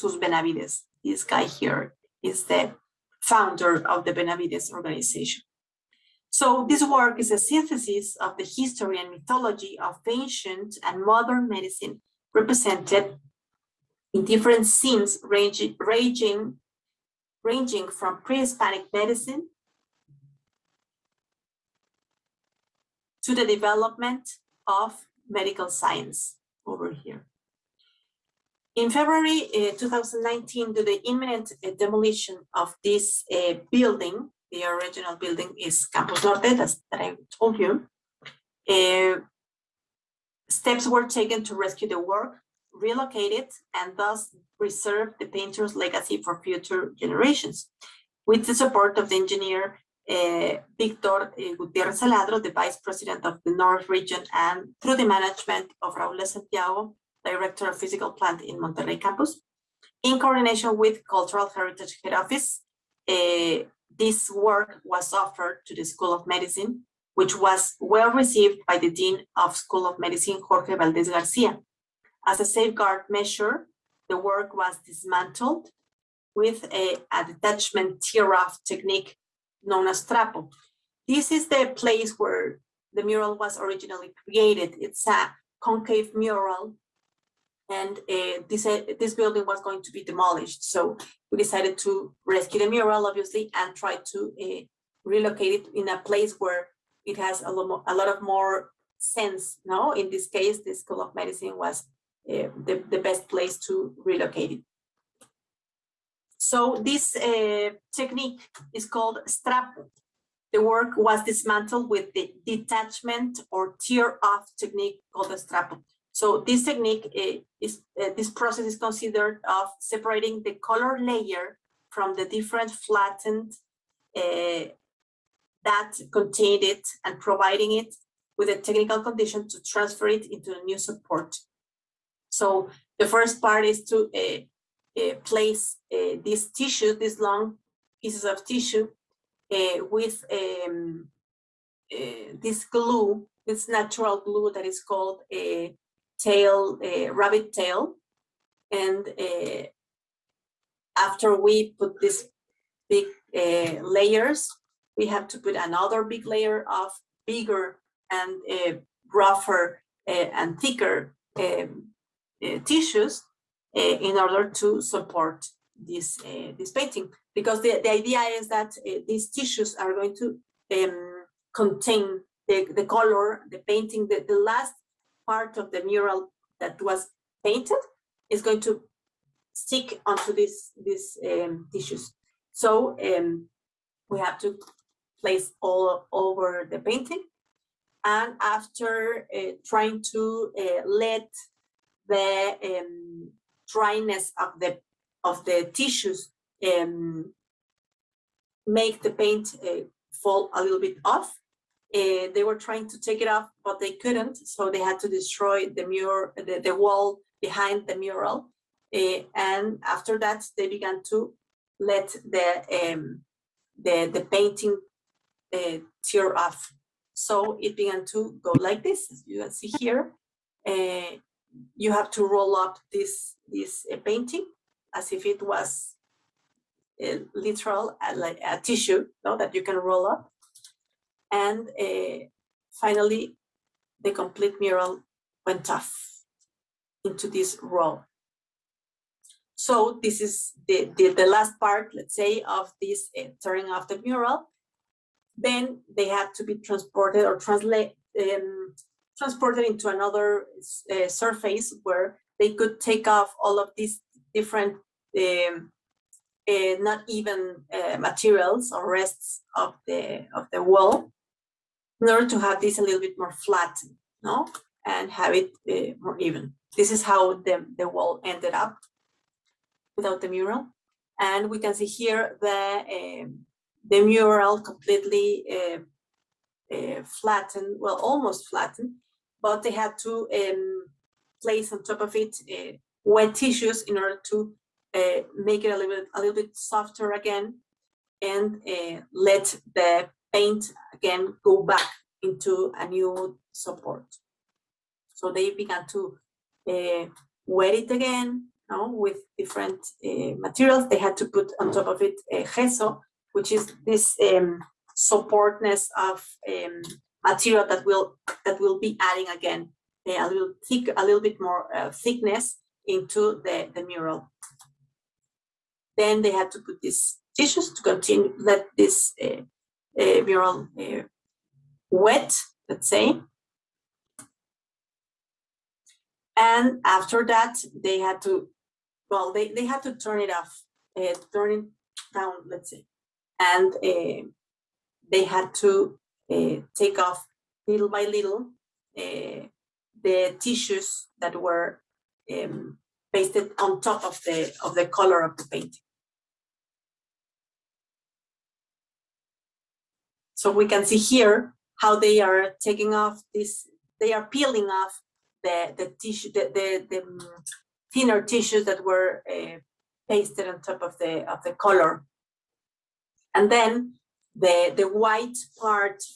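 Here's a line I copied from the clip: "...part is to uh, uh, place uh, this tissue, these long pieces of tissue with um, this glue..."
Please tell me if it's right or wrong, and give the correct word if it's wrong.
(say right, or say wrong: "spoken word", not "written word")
right.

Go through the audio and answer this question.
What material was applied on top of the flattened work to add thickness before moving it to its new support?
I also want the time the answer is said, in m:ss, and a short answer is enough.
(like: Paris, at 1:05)
Gesso, at 5:02.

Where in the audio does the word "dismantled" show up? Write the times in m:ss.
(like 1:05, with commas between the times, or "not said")
1:14, 1:51.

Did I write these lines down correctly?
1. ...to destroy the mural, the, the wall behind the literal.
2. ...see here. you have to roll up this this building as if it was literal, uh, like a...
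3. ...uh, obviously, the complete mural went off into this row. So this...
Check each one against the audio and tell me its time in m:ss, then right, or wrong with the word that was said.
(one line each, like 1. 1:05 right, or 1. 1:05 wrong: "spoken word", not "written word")
1. 3:24 wrong: "mural", not "literal"
2. 3:39 wrong: "painting", not "building"
3. 3:51 wrong: "finally", not "obviously".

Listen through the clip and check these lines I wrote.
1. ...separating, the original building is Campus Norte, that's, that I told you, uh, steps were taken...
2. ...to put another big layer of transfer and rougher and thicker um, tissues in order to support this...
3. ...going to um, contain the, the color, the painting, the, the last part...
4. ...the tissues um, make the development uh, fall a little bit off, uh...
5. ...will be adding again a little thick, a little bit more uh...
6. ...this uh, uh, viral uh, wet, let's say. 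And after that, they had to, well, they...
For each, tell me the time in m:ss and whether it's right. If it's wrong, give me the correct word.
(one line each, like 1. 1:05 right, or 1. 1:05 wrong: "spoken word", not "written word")
1. 0:33 wrong: "building", not "separating"
2. 2:35 wrong: "bigger", not "transfer"
3. 2:49 right
4. 3:15 wrong: "paint", not "development"
5. 5:08 right
6. 5:18 right.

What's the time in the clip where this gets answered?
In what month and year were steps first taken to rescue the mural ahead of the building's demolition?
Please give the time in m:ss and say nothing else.
0:28.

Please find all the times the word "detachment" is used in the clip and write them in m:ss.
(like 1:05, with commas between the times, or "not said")
1:17, 1:52.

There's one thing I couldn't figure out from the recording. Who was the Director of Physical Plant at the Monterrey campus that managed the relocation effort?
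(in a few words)
Raúl Santiago.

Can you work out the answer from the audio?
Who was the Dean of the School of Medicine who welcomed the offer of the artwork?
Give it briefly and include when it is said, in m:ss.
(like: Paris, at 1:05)
Jorge Valdez Garcia, at 1:10.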